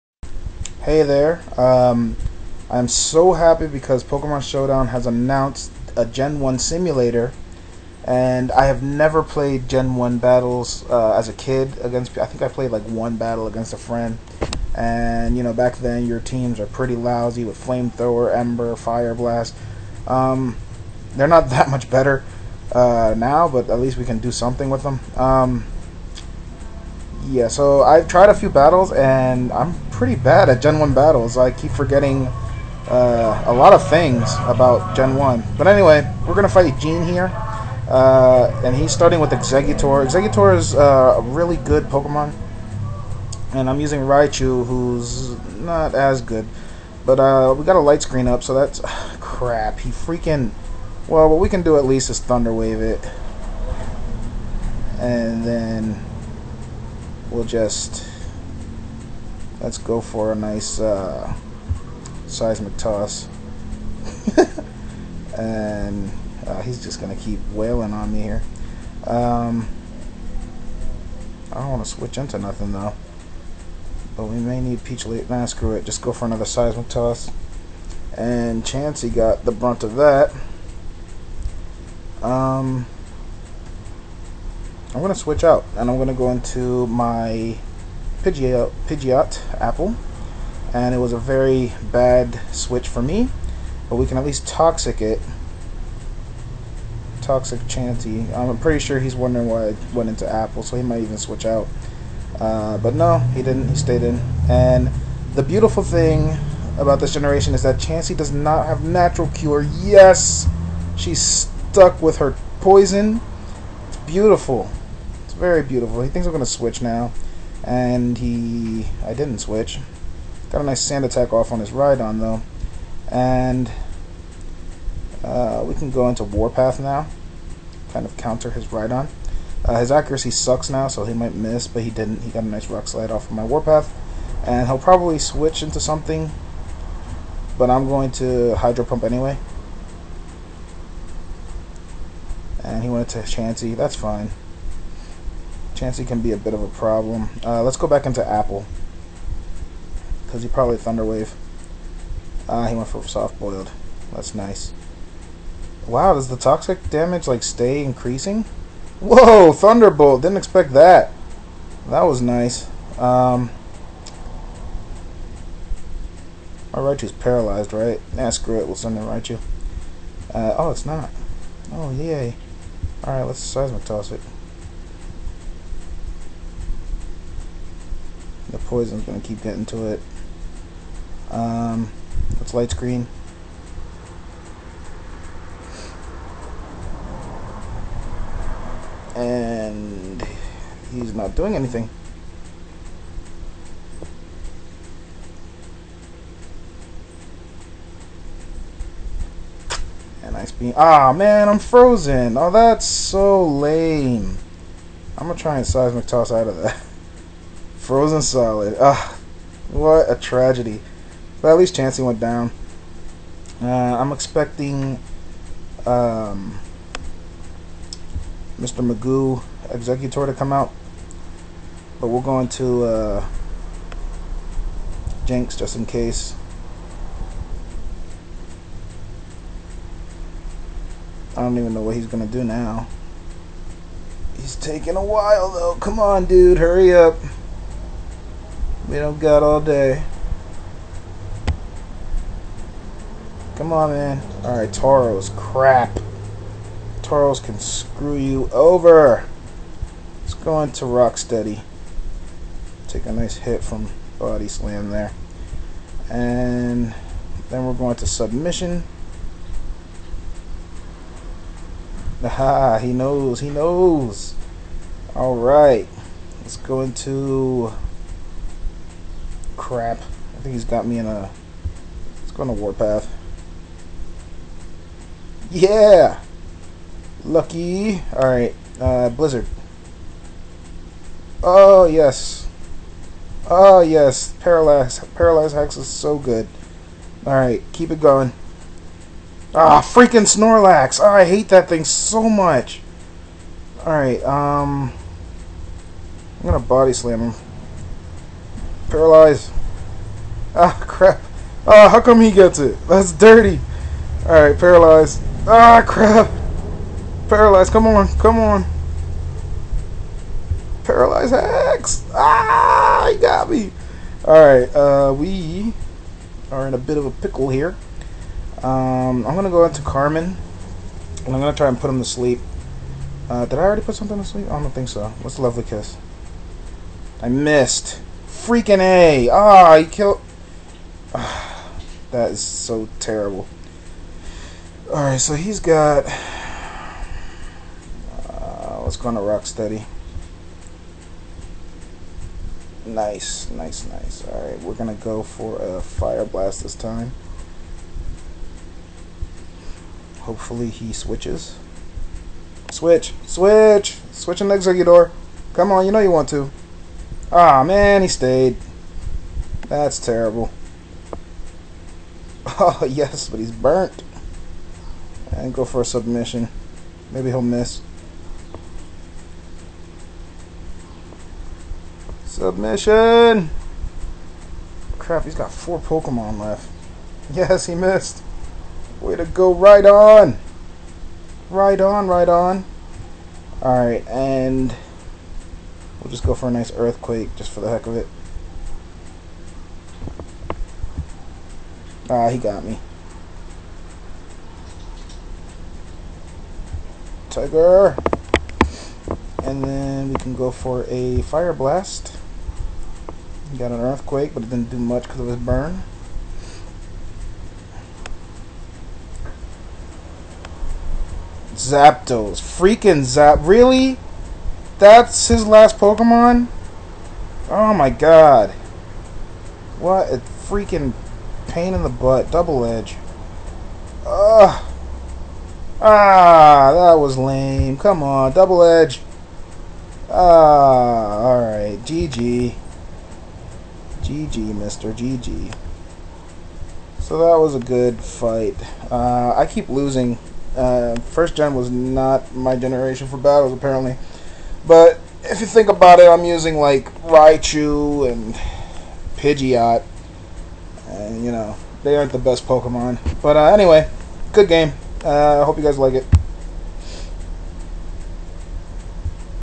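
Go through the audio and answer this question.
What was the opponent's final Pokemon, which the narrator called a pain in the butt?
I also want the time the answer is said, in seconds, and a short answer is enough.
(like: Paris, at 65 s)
Zapdos, at 411 s.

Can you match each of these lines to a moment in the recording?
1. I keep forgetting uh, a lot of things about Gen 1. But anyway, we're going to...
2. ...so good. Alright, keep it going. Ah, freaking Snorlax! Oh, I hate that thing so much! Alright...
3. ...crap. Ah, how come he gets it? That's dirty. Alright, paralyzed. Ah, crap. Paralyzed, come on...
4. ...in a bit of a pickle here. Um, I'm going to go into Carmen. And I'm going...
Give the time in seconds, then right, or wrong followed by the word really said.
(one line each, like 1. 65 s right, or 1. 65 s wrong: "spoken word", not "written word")
1. 31 s right
2. 285 s right
3. 300 s right
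4. 316 s right.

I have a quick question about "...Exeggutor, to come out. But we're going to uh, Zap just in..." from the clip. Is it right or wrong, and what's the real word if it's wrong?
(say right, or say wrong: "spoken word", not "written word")
wrong: "Jynx", not "Zap".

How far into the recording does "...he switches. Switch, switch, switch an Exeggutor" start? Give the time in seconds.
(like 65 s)
350 s.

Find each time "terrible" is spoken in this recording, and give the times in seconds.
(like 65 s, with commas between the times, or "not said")
332 s, 359 s.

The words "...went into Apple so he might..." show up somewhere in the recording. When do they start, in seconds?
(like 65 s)
99 s.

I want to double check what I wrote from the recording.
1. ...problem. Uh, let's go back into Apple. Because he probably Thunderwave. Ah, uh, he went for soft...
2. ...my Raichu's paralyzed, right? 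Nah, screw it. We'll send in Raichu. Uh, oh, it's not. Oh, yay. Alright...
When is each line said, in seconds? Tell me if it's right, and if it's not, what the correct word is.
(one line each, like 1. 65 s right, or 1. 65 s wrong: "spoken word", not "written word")
1. 146 s right
2. 166 s right.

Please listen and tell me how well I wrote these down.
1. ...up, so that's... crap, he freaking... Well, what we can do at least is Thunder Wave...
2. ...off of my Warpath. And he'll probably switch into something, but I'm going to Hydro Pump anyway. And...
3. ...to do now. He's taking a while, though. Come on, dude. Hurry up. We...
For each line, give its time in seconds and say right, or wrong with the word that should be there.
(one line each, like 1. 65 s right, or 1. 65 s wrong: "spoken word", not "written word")
1. 48 s right
2. 133 s right
3. 232 s right.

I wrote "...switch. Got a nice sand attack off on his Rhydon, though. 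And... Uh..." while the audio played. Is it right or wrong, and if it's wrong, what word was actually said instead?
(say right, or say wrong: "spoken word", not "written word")
right.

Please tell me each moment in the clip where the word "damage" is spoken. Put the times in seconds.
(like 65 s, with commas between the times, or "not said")
156 s.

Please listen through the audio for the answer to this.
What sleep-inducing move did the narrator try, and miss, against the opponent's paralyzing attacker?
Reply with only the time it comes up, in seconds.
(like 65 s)
325 s.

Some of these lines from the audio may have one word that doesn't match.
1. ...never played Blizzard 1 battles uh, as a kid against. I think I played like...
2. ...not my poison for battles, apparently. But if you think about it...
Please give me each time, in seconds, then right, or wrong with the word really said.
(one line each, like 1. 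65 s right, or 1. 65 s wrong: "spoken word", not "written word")
1. 8 s wrong: "Gen", not "Blizzard"
2. 441 s wrong: "generation", not "poison".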